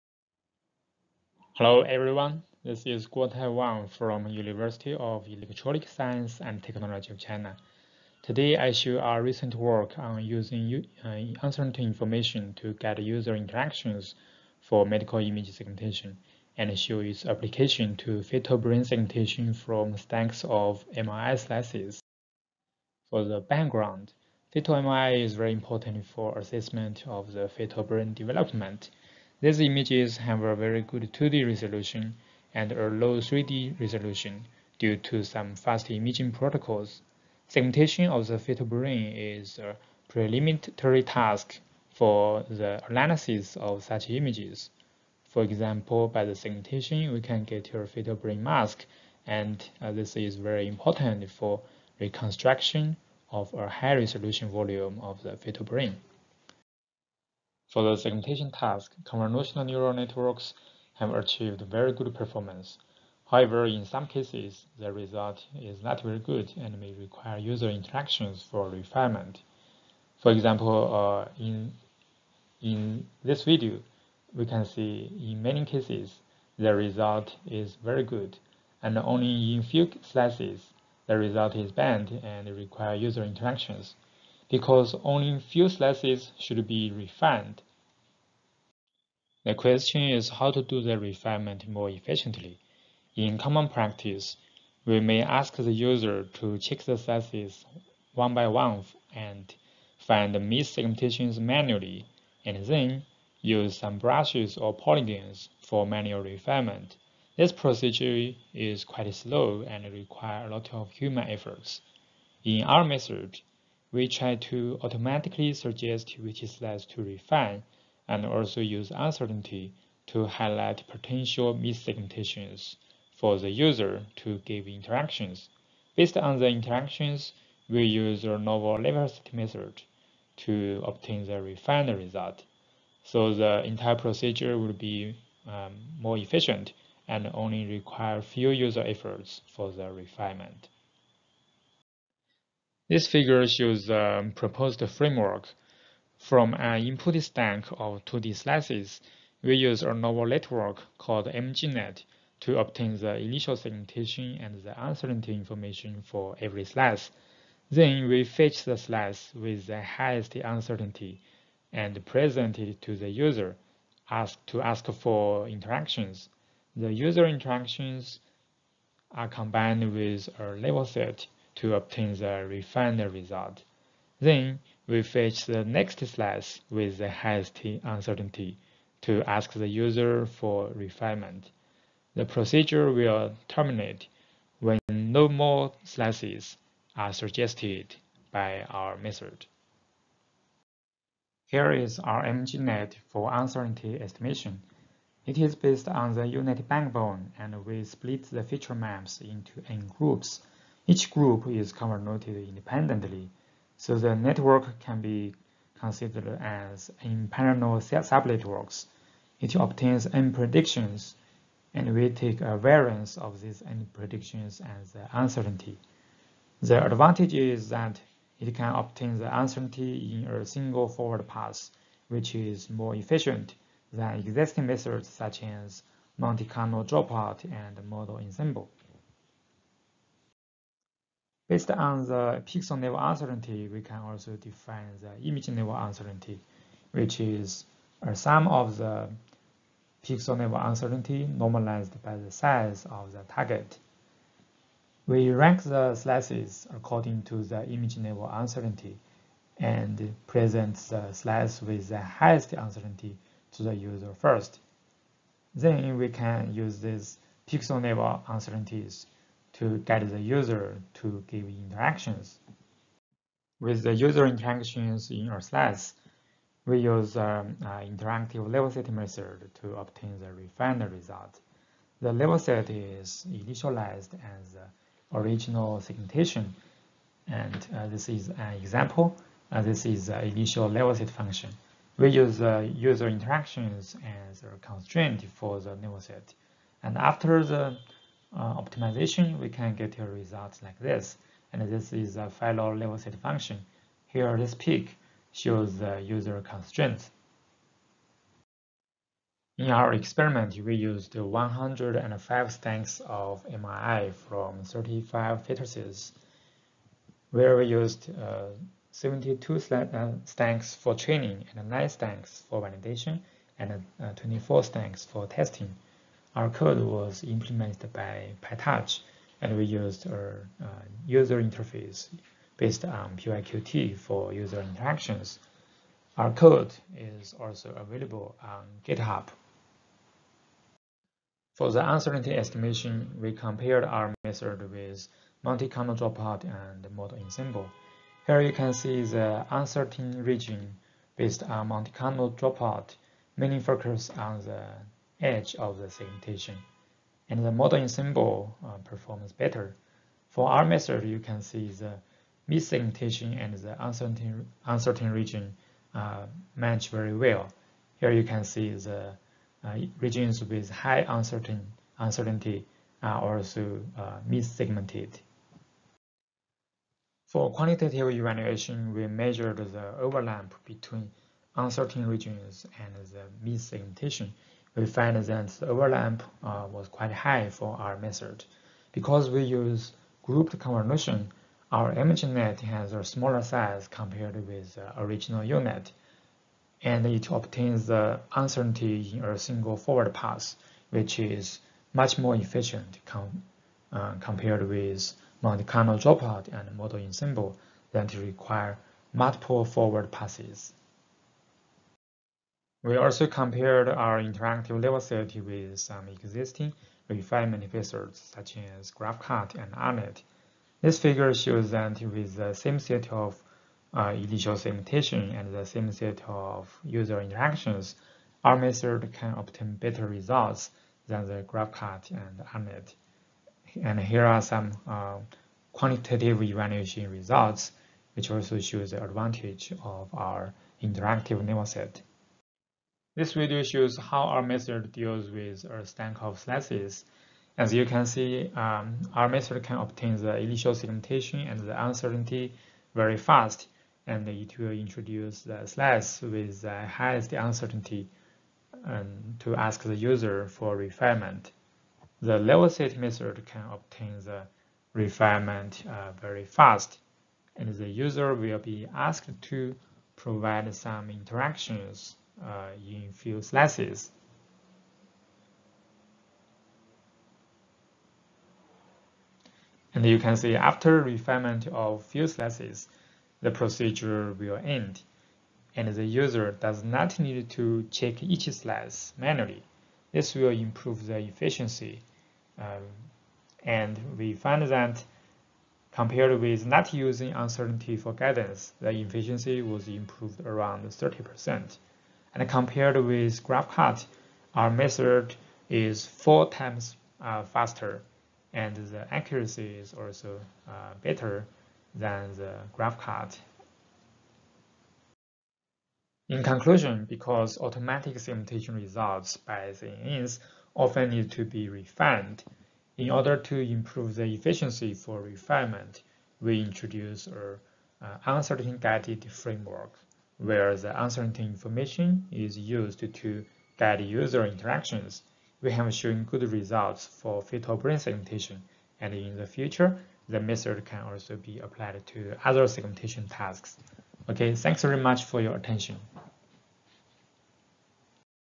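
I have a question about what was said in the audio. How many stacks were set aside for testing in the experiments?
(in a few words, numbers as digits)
24.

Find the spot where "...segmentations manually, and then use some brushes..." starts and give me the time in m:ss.
1:40.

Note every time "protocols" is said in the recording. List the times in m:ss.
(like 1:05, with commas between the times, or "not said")
0:36.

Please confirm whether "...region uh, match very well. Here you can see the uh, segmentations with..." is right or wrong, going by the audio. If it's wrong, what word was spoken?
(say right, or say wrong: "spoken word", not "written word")
wrong: "regions", not "segmentations".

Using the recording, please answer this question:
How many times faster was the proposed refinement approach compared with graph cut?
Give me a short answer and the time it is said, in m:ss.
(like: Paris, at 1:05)
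4, at 8:16.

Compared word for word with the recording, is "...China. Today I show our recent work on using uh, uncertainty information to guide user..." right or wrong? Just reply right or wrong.
right.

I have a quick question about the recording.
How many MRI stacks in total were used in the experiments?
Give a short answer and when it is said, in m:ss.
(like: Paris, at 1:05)
105, at 5:01.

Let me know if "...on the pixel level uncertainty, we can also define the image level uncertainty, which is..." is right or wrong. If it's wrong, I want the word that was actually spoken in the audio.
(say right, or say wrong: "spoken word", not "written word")
right.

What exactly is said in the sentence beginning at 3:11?
Here is our MGNet for uncertainty estimation.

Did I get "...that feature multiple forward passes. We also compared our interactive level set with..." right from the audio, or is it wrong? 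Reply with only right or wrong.
wrong.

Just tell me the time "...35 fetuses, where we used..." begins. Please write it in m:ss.
5:04.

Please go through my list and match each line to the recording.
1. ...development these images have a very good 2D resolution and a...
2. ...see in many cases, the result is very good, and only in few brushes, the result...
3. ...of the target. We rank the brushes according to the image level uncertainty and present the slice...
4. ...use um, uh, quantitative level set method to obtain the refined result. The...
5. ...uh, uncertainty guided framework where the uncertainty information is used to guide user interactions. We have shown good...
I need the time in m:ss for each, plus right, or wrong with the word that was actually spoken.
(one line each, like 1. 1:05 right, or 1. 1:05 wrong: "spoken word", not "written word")
1. 0:28 right
2. 1:14 wrong: "slices", not "brushes"
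3. 4:02 wrong: "slices", not "brushes"
4. 4:26 wrong: "interactive", not "quantitative"
5. 8:38 right.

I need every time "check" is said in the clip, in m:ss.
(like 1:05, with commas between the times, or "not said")
1:36, 7:57.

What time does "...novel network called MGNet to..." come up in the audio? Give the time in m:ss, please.
2:29.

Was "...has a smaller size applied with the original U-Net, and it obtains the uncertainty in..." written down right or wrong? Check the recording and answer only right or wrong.
wrong.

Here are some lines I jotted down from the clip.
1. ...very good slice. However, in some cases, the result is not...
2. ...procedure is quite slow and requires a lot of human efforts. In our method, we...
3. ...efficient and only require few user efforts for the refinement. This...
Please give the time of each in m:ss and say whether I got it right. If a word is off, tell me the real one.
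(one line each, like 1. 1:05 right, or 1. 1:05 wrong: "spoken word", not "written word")
1. 1:01 wrong: "performance", not "slice"
2. 1:47 right
3. 2:16 right.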